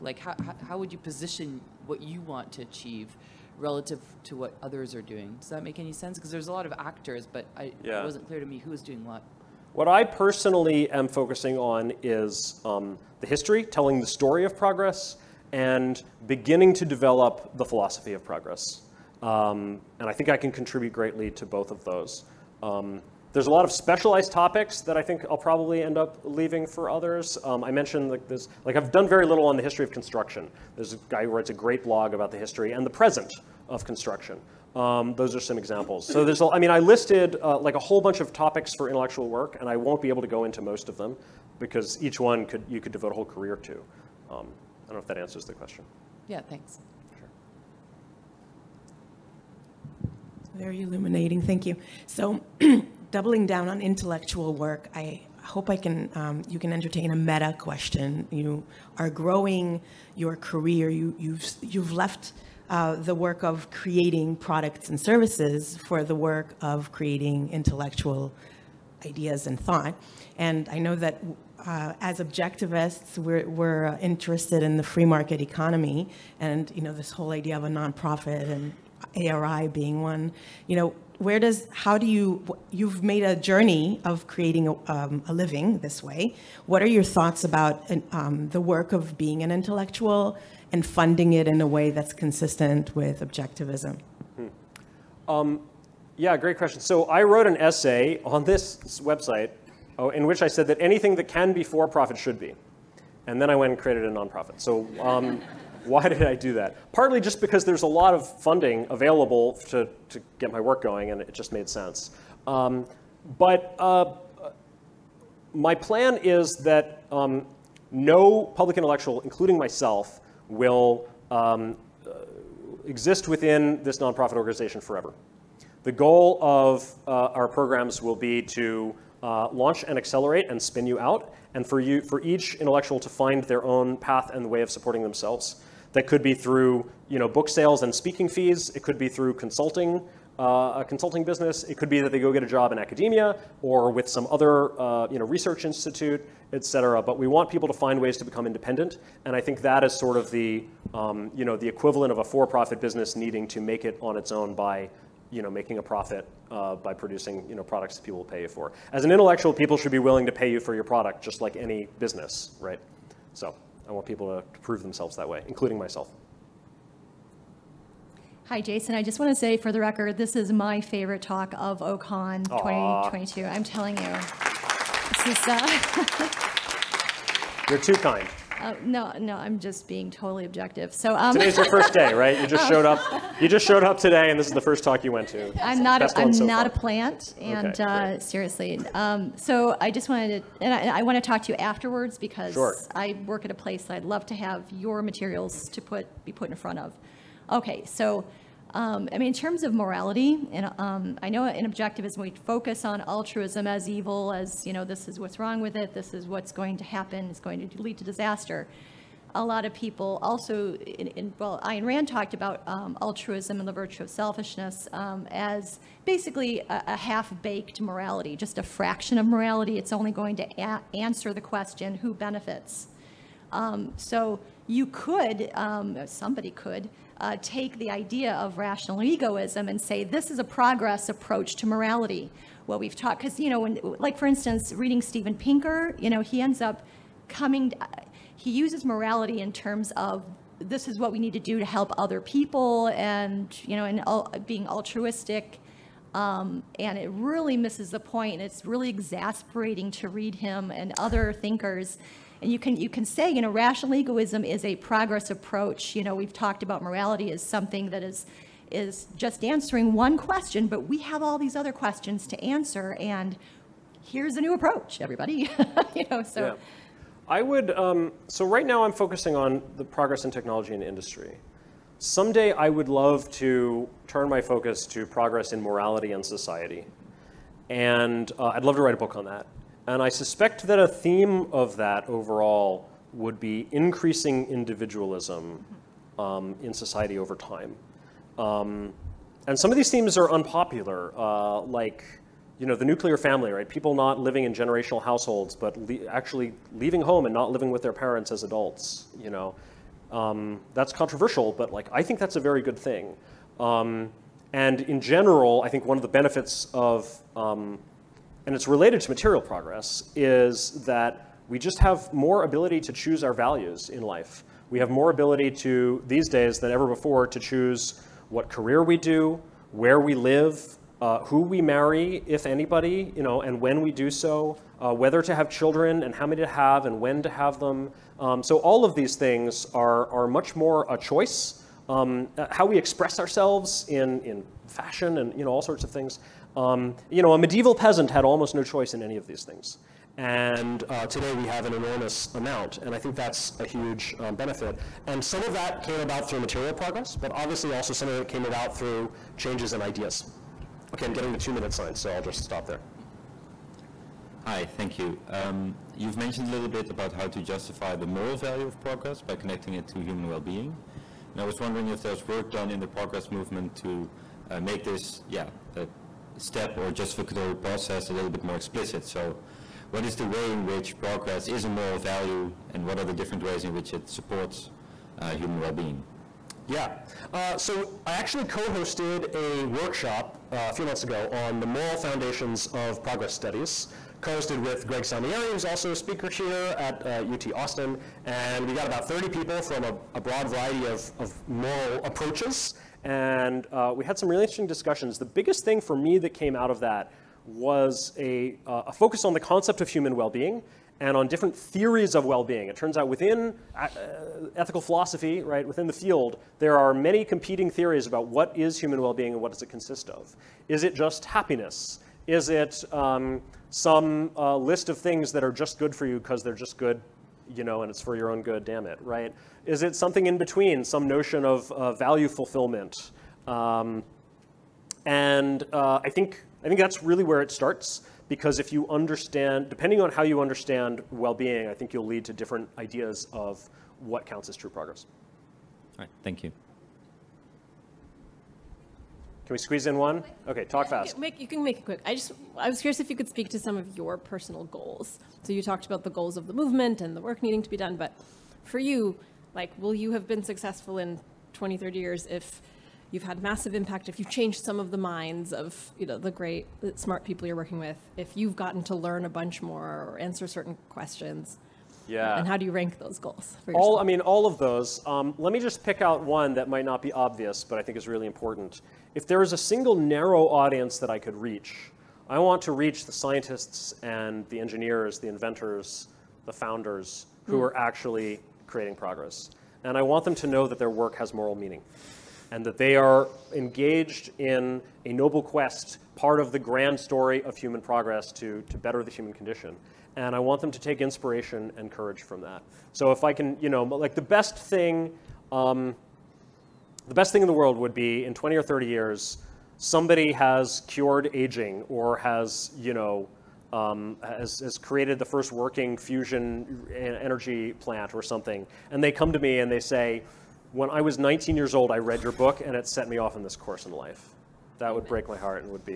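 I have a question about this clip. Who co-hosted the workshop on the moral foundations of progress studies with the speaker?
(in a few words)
Greg Salmieri.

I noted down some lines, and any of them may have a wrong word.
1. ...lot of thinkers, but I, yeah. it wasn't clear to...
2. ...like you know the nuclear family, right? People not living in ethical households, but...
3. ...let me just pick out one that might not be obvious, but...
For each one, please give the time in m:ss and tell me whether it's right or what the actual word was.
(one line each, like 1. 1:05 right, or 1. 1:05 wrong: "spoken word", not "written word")
1. 0:06 wrong: "actors", not "thinkers"
2. 4:51 wrong: "generational", not "ethical"
3. 7:45 right.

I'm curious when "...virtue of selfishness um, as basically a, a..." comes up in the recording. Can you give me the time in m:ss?
3:33.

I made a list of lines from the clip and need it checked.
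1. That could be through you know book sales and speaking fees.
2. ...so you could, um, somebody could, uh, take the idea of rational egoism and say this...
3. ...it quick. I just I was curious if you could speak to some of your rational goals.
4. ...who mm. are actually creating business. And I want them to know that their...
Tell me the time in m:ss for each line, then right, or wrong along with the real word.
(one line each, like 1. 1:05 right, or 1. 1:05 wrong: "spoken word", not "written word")
1. 2:15 right
2. 3:43 right
3. 7:21 wrong: "personal", not "rational"
4. 7:57 wrong: "progress", not "business".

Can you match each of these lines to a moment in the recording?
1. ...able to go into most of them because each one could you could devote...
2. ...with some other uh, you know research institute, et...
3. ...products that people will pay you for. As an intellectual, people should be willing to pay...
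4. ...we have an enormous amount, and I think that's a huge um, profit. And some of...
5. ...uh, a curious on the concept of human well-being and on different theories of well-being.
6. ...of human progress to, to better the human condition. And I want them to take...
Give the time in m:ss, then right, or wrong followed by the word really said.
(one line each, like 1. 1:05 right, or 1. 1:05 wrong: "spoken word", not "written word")
1. 0:40 right
2. 2:23 right
3. 2:37 right
4. 5:41 wrong: "benefit", not "profit"
5. 6:38 wrong: "focus", not "curious"
6. 8:07 right.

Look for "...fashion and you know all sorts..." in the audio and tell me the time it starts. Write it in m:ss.
5:34.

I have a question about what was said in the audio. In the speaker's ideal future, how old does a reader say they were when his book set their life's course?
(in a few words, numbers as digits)
19.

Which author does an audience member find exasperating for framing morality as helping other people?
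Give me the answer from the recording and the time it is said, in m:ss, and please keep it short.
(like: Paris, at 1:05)
Steven Pinker, at 3:55.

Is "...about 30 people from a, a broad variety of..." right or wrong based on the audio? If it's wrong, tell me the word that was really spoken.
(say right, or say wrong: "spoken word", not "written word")
right.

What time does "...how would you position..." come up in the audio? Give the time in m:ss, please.
0:00.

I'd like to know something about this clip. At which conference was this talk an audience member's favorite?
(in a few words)
OCON 2022.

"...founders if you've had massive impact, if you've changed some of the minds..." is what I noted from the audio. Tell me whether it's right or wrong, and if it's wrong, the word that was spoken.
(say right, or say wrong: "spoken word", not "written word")
wrong: "years", not "founders".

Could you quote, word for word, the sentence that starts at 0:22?
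Um, there's a lot of specialized topics that I think I'll probably end up leaving for others.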